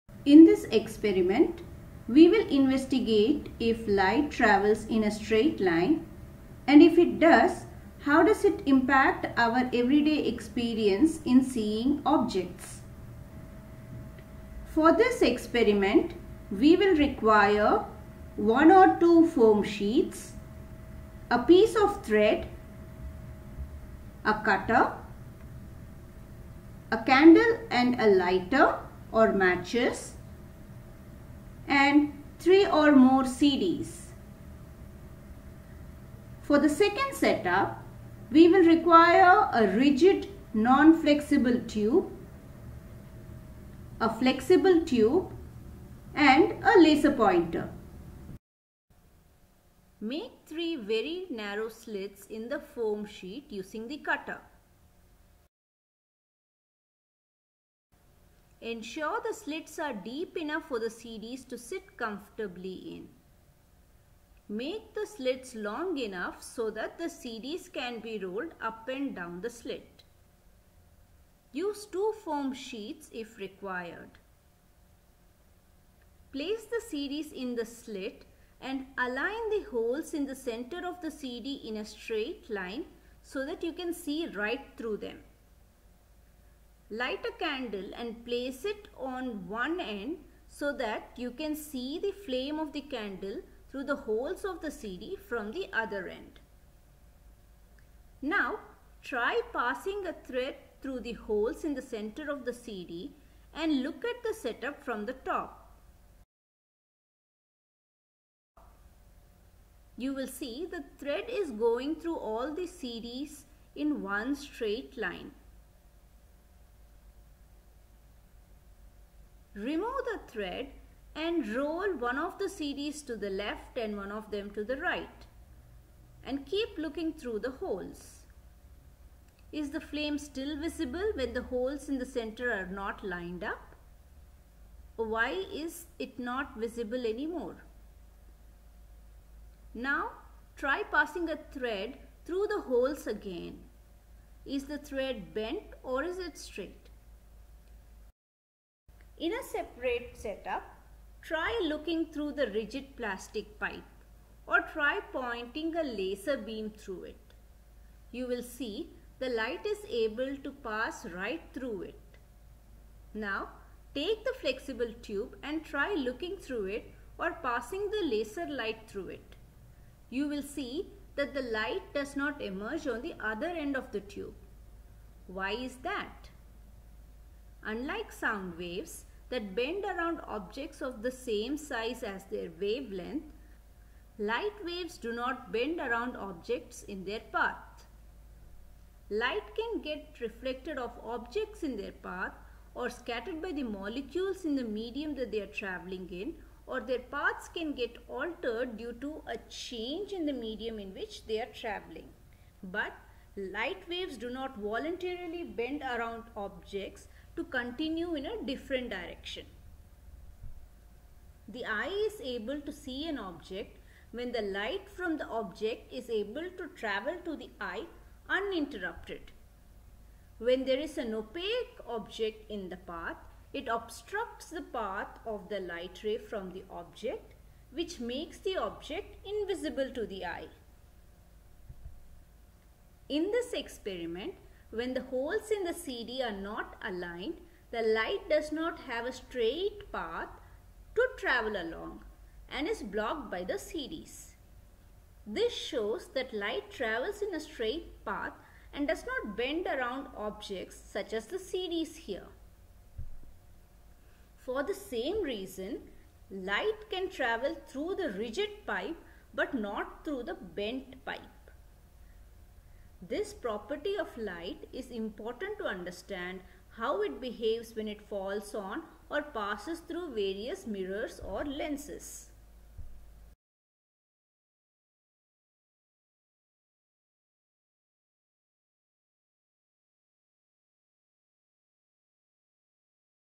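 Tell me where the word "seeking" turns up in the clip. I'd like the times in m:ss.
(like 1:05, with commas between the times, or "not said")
not said.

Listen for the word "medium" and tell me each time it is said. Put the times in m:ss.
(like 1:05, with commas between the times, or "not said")
3:14, 3:20.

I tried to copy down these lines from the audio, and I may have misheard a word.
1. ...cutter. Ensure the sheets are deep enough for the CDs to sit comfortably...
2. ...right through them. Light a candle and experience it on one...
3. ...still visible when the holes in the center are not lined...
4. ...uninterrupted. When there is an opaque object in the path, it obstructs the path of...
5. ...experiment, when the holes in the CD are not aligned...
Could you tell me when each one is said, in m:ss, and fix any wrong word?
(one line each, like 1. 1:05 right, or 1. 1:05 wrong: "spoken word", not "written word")
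1. 0:53 wrong: "slits", not "sheets"
2. 1:24 wrong: "place", not "experience"
3. 2:10 right
4. 3:38 right
5. 3:53 right.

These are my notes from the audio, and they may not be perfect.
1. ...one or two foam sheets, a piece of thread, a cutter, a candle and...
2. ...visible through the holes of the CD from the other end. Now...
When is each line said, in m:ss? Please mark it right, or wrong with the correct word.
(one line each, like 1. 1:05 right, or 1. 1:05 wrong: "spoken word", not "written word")
1. 0:18 right
2. 1:32 wrong: "candle", not "visible".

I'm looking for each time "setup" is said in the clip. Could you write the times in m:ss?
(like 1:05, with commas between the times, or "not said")
0:37, 1:44, 2:30.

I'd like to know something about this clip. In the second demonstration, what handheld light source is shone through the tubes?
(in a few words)
laser pointer.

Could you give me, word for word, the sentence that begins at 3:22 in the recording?
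But light waves do not voluntarily bend around objects to continue in a different direction.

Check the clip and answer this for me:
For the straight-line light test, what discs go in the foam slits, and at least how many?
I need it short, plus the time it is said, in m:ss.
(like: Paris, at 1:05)
3 or more CDs, at 0:32.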